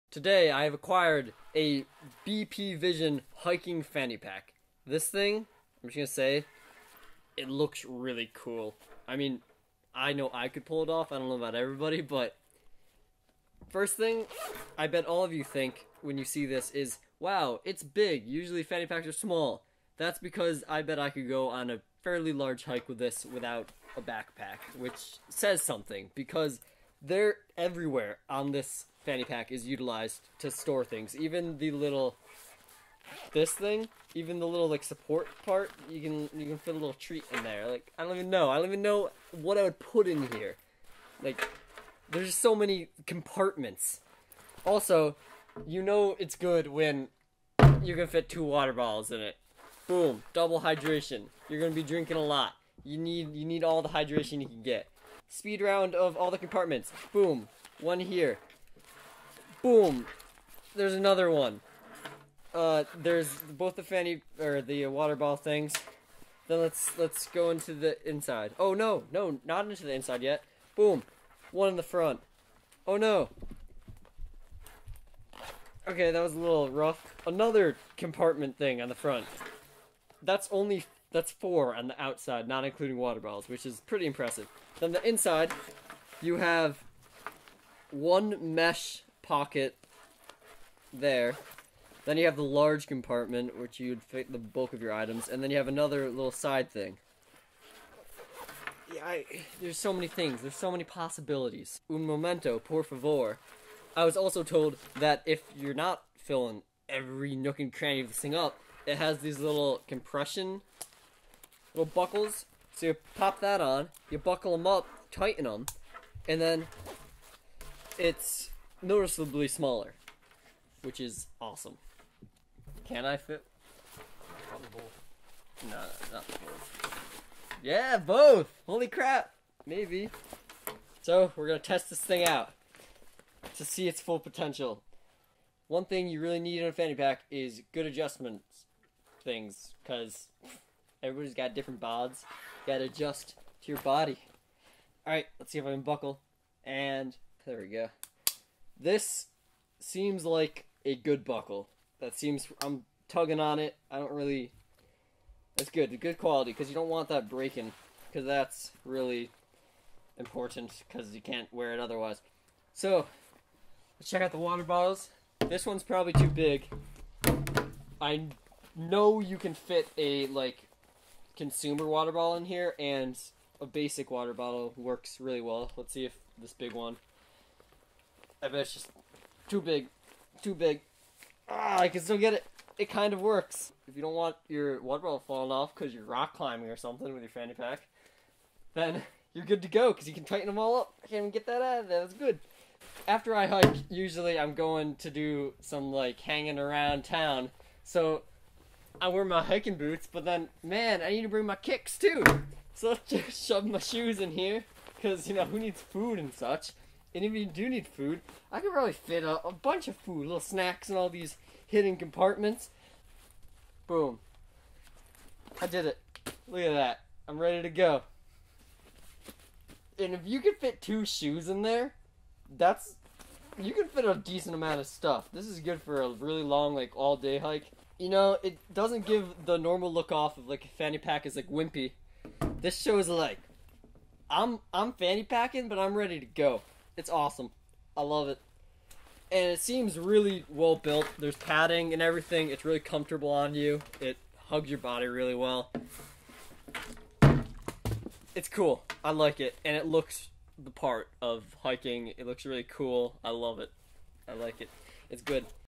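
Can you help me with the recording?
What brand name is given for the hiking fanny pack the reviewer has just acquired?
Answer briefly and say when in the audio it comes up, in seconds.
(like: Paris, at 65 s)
BP Vision, at 2 s.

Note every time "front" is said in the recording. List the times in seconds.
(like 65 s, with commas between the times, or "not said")
71 s, 78 s.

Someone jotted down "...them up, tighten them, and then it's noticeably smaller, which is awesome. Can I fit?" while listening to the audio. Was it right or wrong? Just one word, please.
right.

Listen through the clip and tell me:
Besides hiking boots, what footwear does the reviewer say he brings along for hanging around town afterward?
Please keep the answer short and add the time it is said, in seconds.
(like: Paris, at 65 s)
kicks, at 201 s.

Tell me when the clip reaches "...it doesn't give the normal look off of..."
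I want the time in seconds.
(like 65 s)
228 s.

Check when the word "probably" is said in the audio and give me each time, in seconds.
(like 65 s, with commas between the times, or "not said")
124 s, 165 s, 208 s.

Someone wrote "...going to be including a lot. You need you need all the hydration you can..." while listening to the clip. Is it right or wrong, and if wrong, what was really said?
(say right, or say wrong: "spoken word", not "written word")
wrong: "drinking", not "including".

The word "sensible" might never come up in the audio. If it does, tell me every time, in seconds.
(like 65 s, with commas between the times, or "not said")
not said.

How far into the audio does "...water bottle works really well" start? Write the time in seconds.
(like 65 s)
174 s.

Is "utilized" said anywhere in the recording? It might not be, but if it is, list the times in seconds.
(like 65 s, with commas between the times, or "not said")
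29 s.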